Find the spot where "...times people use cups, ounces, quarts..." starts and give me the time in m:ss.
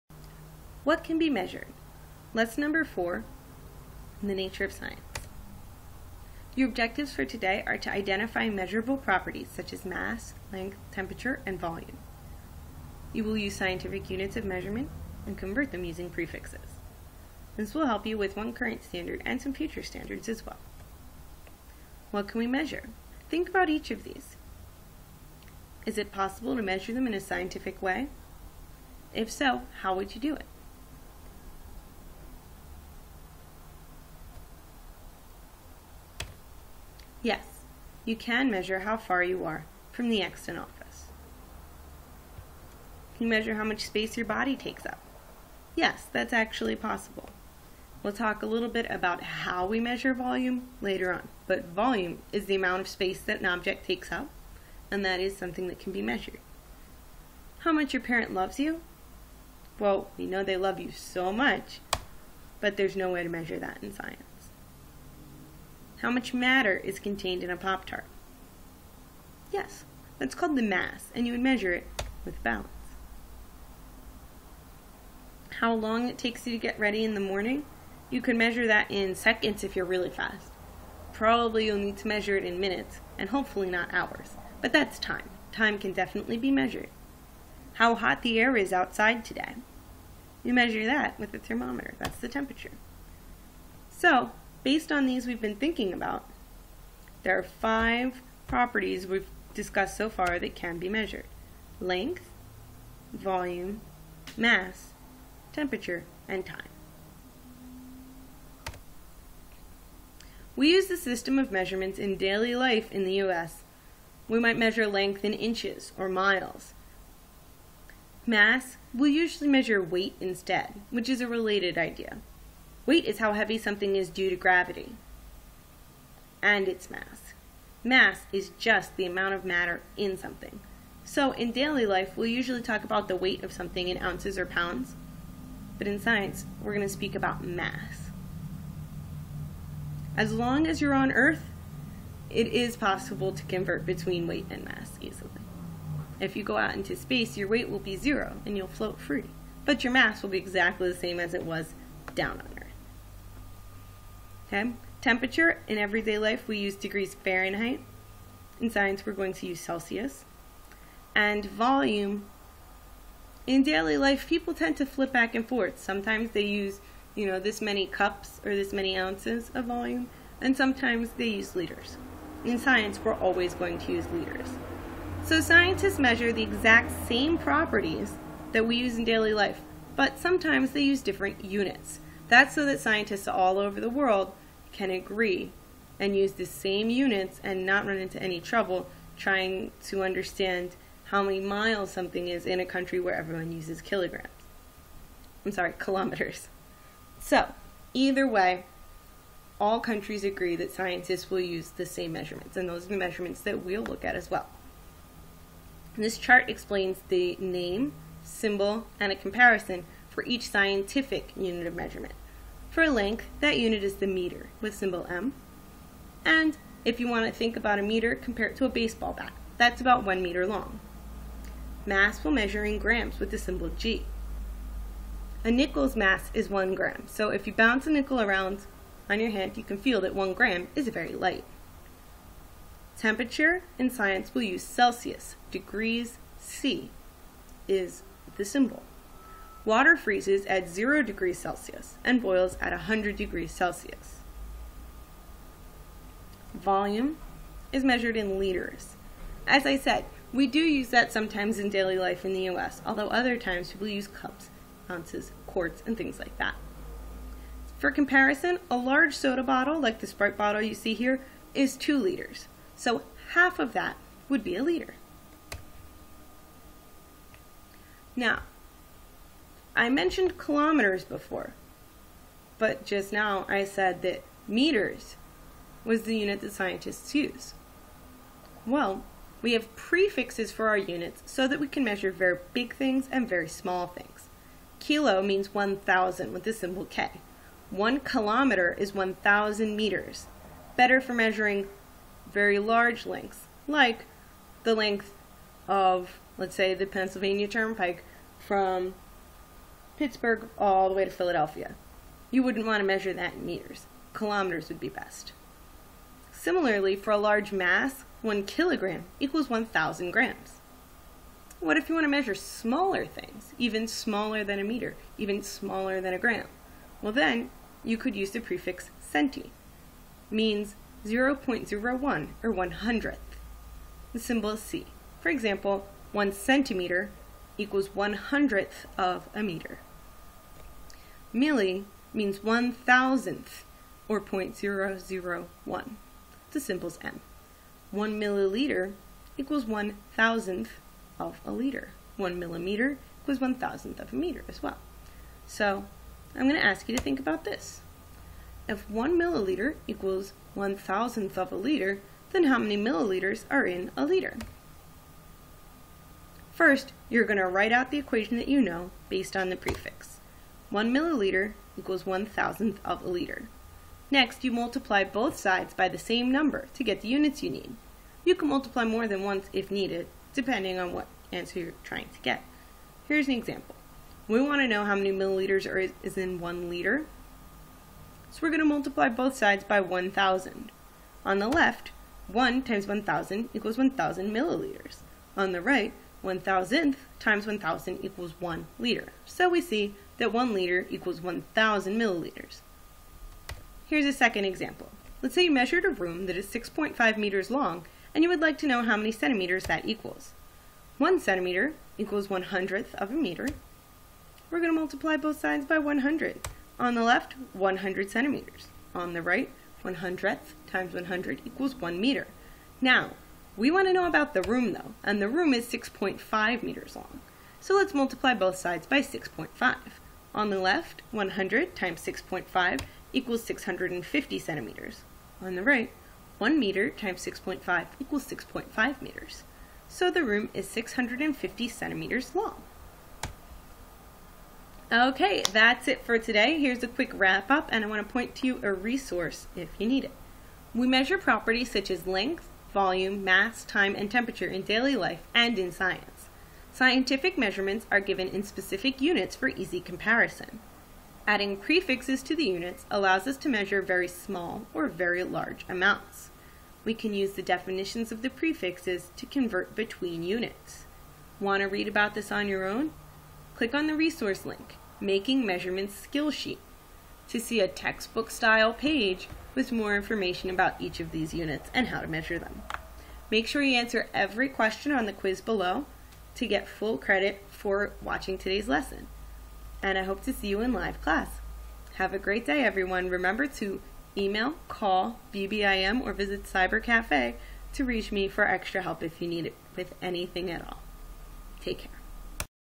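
4:13.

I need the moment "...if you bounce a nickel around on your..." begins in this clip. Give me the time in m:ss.
3:47.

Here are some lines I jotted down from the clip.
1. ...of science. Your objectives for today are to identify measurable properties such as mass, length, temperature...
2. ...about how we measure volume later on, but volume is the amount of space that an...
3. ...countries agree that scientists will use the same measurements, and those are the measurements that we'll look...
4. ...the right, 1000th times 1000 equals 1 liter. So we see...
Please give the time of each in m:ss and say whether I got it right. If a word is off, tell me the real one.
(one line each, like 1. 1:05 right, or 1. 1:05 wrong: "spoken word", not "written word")
1. 0:04 right
2. 0:48 right
3. 3:19 right
4. 6:25 right.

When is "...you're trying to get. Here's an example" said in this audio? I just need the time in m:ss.
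6:11.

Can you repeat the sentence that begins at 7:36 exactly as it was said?
We can use the definitions of the prefixes to convert between units.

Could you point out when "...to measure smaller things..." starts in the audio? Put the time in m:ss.
5:12.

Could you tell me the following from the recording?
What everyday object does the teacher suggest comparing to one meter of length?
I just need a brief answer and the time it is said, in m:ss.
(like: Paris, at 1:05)
Baseball bat, at 3:38.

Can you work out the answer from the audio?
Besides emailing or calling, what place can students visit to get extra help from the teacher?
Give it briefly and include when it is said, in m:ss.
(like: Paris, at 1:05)
Cyber Cafe, at 8:06.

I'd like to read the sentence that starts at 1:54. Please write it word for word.
We might measure length in inches or miles.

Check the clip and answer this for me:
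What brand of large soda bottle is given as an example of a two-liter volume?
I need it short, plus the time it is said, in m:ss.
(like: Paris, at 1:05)
Sprite, at 4:20.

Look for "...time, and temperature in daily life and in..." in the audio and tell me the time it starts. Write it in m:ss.
7:23.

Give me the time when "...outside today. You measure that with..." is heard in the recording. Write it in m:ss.
1:28.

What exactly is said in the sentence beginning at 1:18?
You could measure that in seconds if you're really fast.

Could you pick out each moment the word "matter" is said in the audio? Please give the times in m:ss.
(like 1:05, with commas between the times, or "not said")
1:06, 2:09.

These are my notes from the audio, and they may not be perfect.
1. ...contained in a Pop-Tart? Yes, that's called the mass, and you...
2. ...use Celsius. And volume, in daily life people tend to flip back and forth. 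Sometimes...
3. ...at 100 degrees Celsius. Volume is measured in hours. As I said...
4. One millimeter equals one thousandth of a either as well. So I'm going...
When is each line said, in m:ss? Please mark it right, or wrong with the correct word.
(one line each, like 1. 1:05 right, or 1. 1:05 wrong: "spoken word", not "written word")
1. 1:06 right
2. 2:39 right
3. 4:02 wrong: "liters", not "hours"
4. 5:42 wrong: "meter", not "either".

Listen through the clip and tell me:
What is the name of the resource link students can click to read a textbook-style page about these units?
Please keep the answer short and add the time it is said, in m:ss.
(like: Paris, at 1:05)
Making Measurements Skill Sheet, at 7:44.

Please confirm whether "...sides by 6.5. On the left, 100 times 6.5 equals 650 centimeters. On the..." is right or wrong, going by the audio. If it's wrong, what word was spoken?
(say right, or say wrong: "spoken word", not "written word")
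right.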